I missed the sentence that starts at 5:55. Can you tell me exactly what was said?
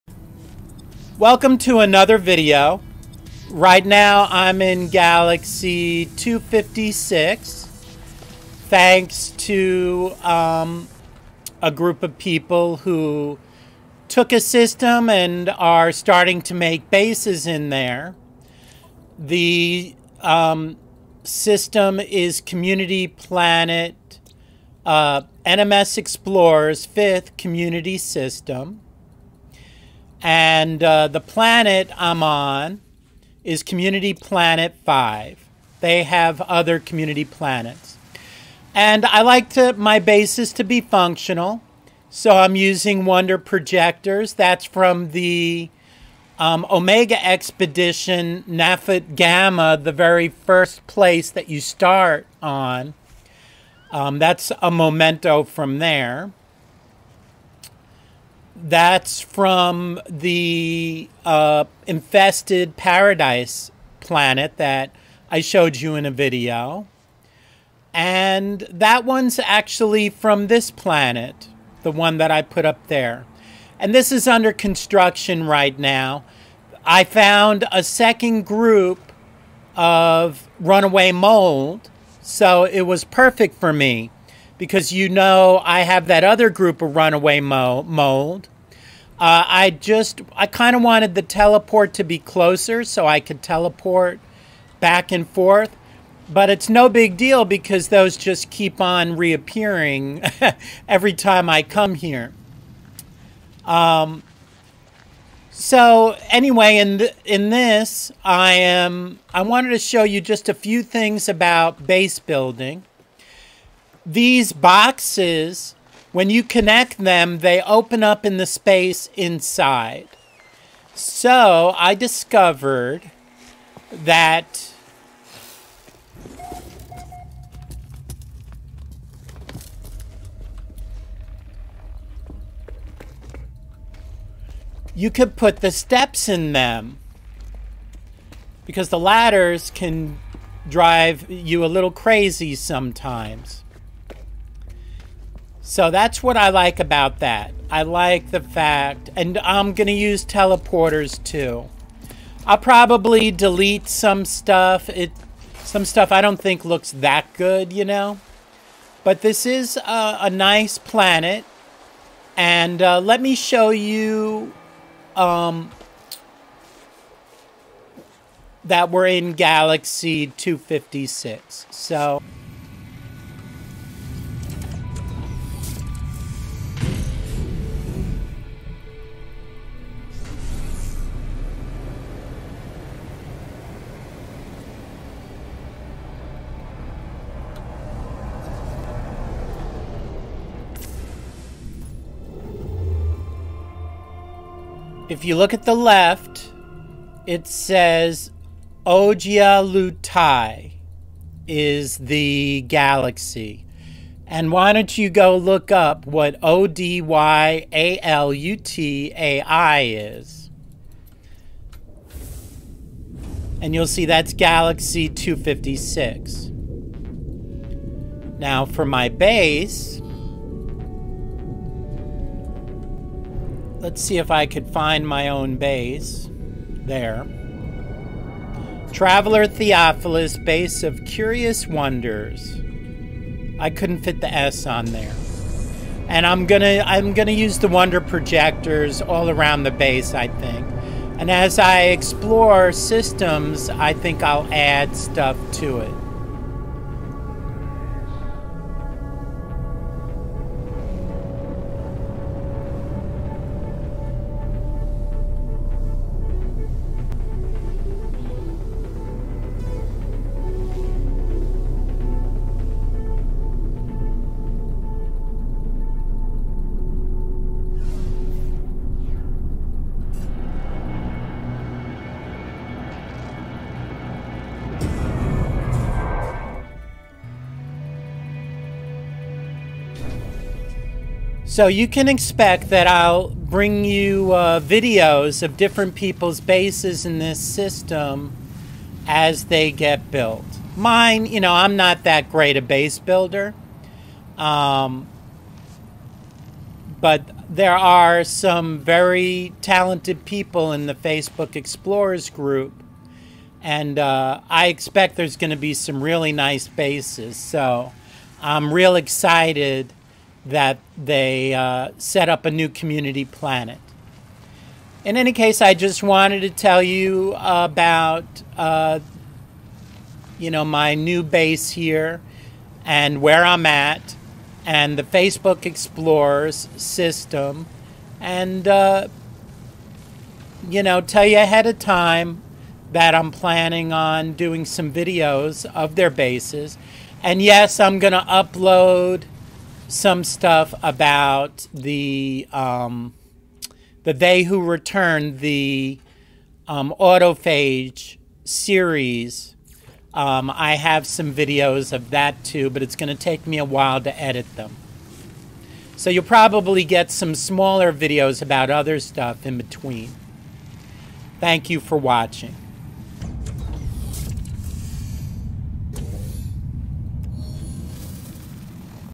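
So you'll probably get some smaller videos about other stuff in between.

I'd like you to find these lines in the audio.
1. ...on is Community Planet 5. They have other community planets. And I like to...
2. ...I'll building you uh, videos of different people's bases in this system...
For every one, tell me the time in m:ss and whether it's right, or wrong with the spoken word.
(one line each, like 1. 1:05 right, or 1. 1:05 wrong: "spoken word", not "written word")
1. 0:32 right
2. 4:42 wrong: "bring", not "building".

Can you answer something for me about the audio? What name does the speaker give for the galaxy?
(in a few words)
Odyalutai.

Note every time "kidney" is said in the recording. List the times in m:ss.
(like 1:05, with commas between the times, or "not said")
not said.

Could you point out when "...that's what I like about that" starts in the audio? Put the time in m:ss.
2:25.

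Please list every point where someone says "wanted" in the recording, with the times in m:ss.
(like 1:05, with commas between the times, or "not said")
1:30, 1:49, 5:16.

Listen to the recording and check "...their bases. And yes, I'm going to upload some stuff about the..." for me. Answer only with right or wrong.
right.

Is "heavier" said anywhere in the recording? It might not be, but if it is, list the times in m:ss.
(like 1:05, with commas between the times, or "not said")
not said.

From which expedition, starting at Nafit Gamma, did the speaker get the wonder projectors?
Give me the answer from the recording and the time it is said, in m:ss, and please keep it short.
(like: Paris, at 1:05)
Omega Expedition, at 0:46.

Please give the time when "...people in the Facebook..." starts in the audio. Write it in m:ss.
5:00.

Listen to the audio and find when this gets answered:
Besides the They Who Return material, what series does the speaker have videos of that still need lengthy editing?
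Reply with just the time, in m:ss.
5:46.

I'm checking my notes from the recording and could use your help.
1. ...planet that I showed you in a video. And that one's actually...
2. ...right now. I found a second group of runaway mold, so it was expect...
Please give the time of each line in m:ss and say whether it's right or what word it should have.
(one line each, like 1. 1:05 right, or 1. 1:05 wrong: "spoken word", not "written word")
1. 1:03 right
2. 1:15 wrong: "perfect", not "expect".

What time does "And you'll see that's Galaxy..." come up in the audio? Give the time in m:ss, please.
3:33.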